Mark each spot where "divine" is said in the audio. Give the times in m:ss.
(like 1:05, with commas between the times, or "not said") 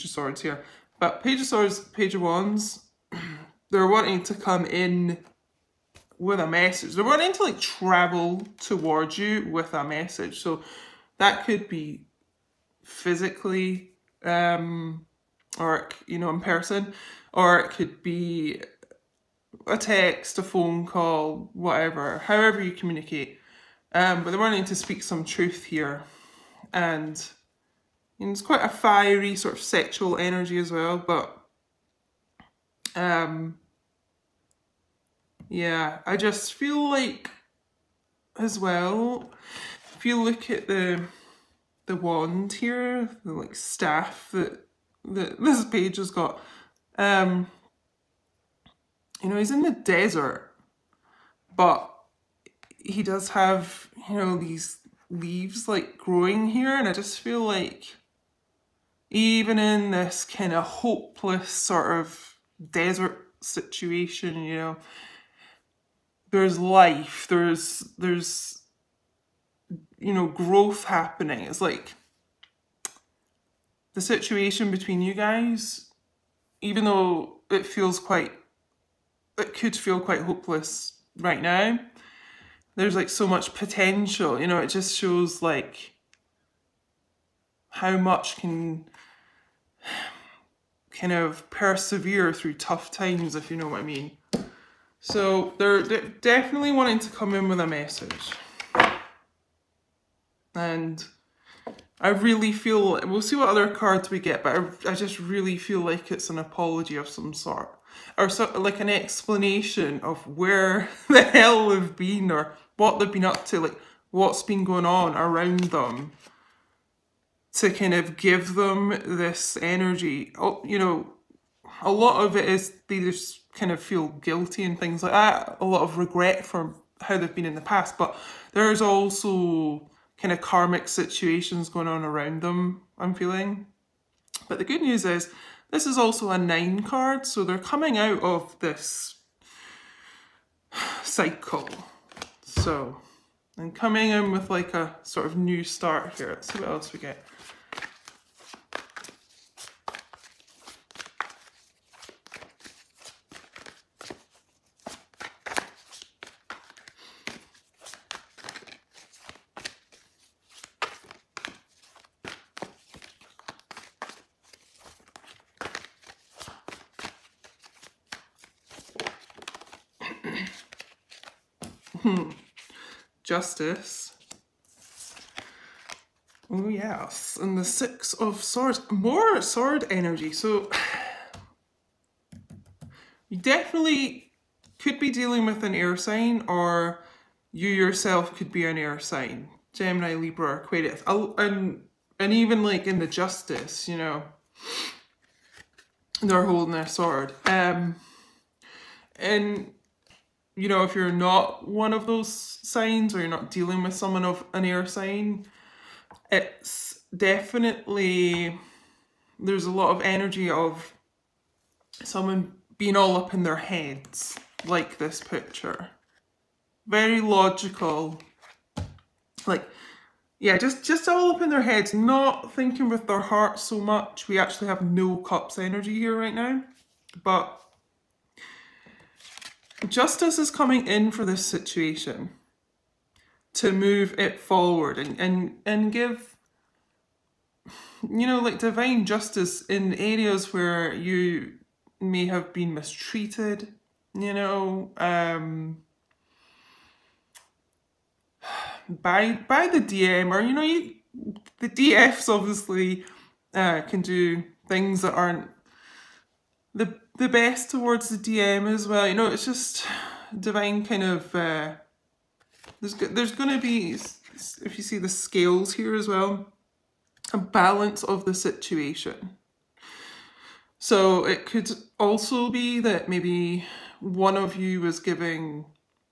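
3:58, 4:20.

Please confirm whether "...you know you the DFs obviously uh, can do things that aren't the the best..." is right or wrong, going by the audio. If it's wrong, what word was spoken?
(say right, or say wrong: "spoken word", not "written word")
right.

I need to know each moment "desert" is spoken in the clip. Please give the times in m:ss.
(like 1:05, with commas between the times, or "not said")
0:49, 1:02.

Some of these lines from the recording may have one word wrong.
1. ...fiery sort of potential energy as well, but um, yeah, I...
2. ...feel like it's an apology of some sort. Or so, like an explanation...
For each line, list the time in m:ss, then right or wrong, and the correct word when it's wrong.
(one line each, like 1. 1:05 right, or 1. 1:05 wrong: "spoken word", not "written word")
1. 0:28 wrong: "sexual", not "potential"
2. 1:45 right.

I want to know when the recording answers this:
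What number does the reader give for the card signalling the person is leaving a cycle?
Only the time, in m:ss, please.
2:16.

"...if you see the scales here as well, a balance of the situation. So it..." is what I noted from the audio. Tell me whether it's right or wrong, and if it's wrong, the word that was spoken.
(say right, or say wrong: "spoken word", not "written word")
right.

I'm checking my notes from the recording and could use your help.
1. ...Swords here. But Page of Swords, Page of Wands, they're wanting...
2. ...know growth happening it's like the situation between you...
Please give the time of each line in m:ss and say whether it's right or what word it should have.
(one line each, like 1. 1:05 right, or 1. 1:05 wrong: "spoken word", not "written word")
1. 0:00 right
2. 1:10 right.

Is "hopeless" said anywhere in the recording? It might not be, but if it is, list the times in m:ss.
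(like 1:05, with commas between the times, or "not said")
1:00, 1:20.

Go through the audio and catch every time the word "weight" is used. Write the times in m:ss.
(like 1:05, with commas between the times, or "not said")
not said.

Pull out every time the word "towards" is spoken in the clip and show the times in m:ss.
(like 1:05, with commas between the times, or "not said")
0:08, 4:17.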